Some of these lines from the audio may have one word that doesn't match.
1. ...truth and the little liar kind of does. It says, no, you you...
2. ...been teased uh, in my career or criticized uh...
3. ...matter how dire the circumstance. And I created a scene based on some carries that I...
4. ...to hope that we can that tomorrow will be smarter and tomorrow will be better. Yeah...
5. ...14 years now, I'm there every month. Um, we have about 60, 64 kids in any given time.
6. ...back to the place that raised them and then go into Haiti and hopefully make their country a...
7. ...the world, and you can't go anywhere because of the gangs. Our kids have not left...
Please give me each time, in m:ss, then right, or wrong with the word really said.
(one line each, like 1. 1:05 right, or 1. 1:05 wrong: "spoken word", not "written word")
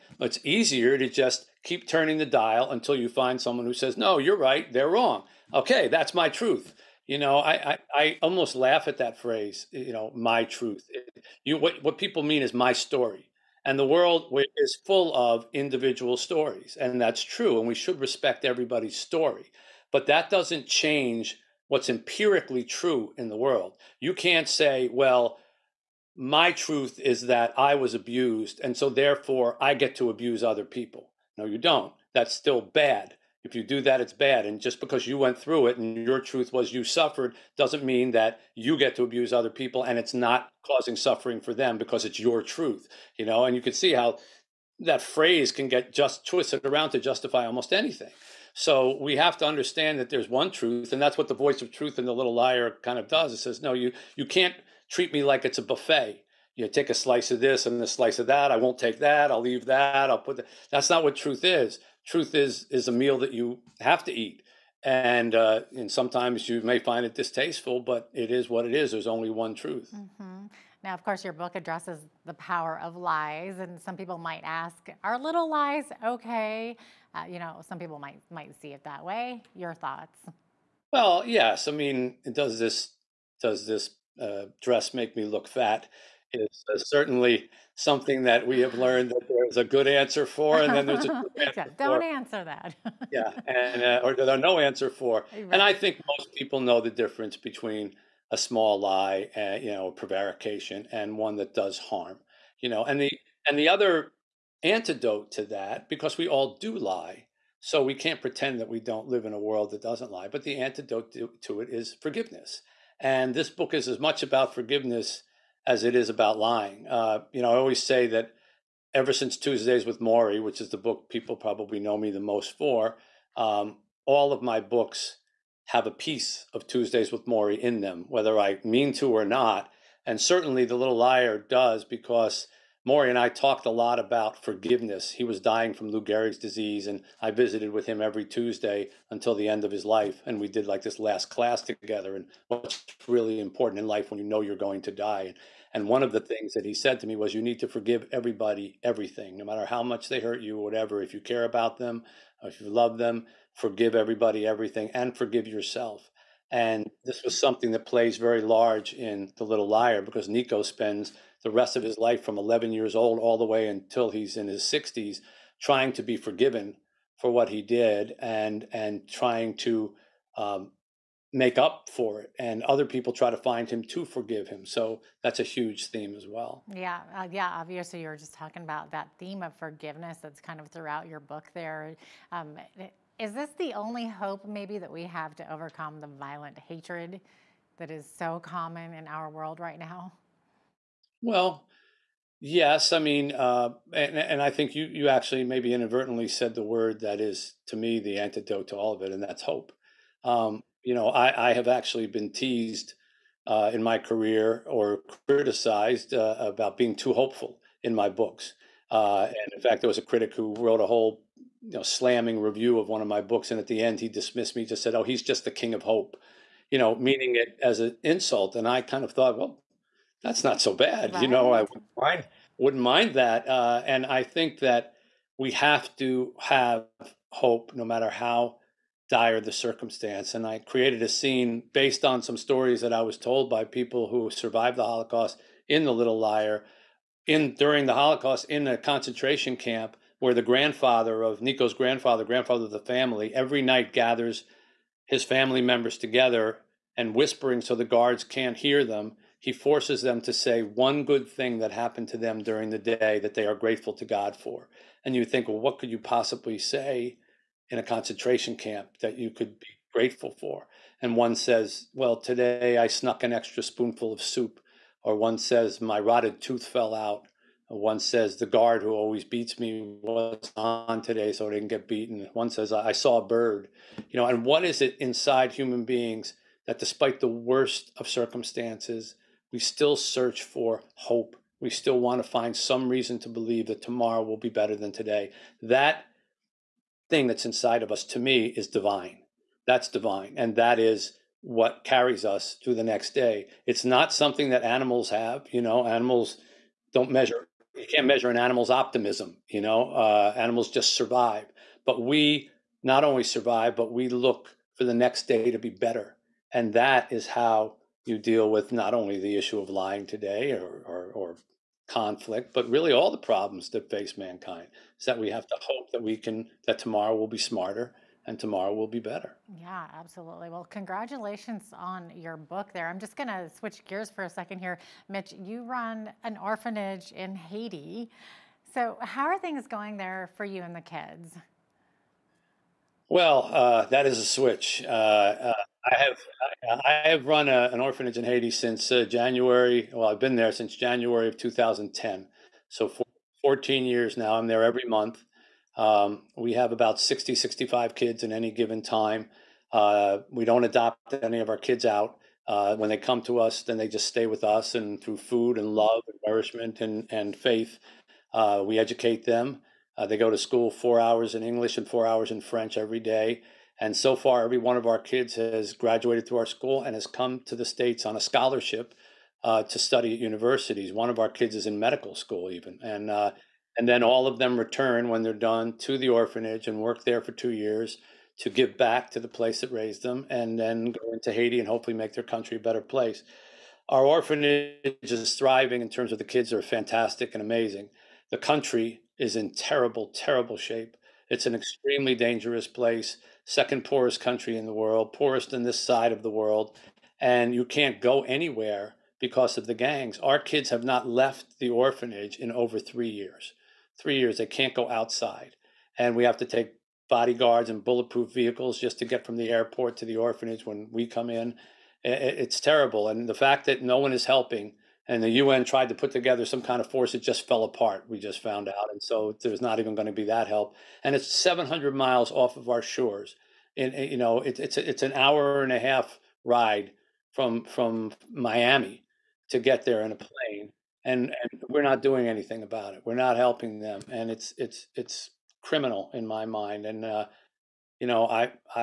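1. 0:51 right
2. 3:22 right
3. 3:47 wrong: "stories", not "carries"
4. 5:15 right
5. 5:43 wrong: "65", not "64"
6. 6:18 right
7. 6:36 right.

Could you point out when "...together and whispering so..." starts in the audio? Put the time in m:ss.
4:05.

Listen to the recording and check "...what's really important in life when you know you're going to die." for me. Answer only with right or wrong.
right.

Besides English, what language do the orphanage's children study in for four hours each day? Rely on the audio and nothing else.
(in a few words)
French.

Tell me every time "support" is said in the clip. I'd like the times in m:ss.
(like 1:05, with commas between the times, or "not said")
not said.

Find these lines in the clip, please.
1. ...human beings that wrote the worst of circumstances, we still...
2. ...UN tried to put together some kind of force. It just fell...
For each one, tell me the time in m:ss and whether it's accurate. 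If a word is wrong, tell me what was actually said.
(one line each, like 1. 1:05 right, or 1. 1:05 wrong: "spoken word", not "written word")
1. 4:35 wrong: "despite", not "wrote"
2. 6:55 right.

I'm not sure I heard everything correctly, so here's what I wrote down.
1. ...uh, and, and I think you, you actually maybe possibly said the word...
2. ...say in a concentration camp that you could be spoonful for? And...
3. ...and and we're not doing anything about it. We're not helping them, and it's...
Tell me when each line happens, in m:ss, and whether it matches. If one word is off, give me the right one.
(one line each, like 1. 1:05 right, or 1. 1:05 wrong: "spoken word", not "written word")
1. 3:13 wrong: "inadvertently", not "possibly"
2. 4:16 wrong: "grateful", not "spoonful"
3. 7:11 right.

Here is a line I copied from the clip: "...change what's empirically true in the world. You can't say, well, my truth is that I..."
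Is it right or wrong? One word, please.
right.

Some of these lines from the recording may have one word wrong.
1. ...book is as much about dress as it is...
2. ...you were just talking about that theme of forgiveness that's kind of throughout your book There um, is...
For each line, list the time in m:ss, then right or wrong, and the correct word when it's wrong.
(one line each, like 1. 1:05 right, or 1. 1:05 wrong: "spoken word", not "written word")
1. 1:53 wrong: "forgiveness", not "dress"
2. 2:58 right.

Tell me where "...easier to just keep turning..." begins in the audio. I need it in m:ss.
0:00.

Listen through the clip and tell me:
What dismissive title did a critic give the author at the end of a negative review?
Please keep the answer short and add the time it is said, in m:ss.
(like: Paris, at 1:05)
The king of hope, at 3:35.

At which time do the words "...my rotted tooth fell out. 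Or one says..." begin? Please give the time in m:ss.
4:25.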